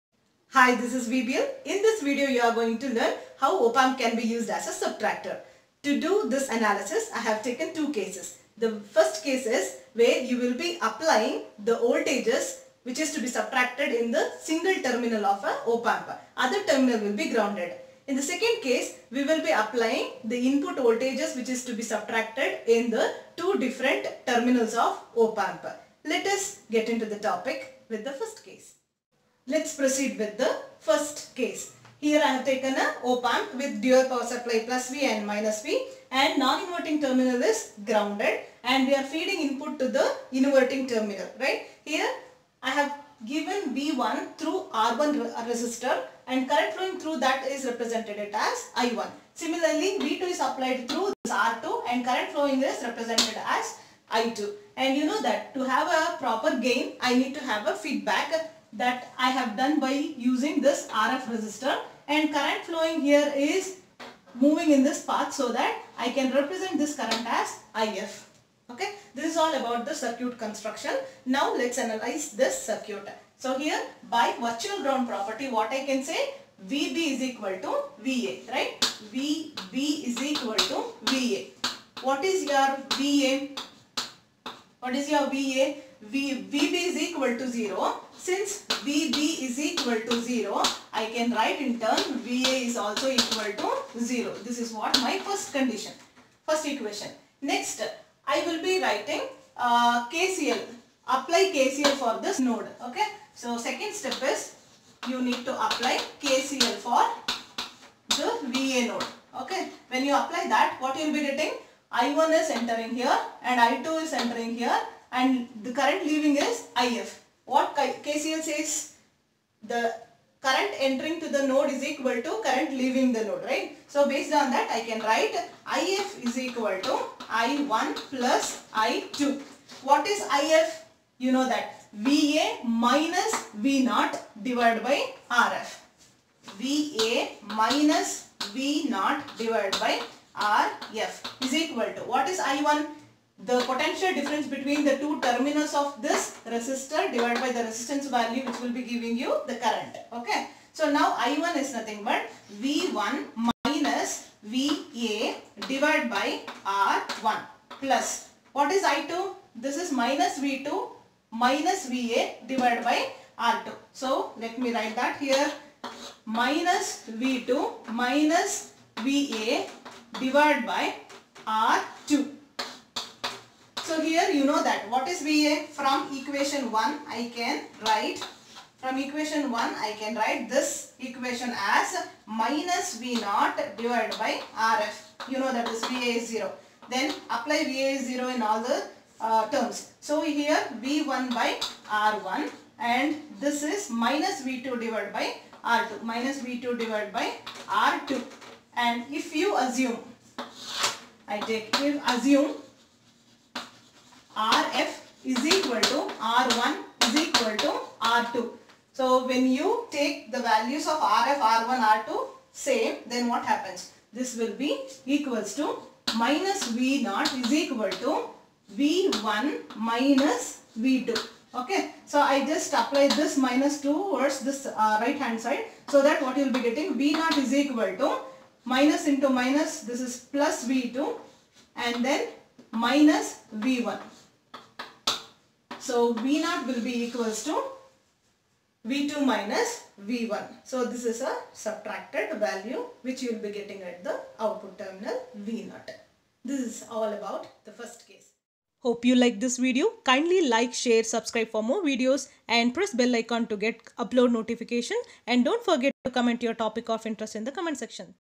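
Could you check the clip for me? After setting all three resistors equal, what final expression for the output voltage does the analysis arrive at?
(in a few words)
V2 minus V1.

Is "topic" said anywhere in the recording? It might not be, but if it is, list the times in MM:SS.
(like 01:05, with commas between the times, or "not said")
00:27, 04:16.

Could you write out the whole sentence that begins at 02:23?
the potential difference between the two terminals of this resistor divided by the resistance value which will be giving you the current.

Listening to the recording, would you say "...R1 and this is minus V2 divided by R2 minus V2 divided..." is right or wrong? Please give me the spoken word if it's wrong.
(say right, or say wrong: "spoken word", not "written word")
right.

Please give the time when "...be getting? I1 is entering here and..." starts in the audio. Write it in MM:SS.
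01:51.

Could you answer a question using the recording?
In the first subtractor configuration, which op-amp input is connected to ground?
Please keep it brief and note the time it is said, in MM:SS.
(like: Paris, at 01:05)
Non-inverting terminal, at 00:36.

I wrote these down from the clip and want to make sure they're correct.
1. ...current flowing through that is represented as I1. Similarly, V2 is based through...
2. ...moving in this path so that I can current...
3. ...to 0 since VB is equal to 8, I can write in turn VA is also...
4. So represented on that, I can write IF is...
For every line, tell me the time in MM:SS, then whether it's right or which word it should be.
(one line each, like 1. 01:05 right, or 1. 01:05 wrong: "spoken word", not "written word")
1. 00:46 wrong: "applied", not "based"
2. 01:04 wrong: "represent", not "current"
3. 01:27 wrong: "0", not "8"
4. 02:03 wrong: "based", not "represented".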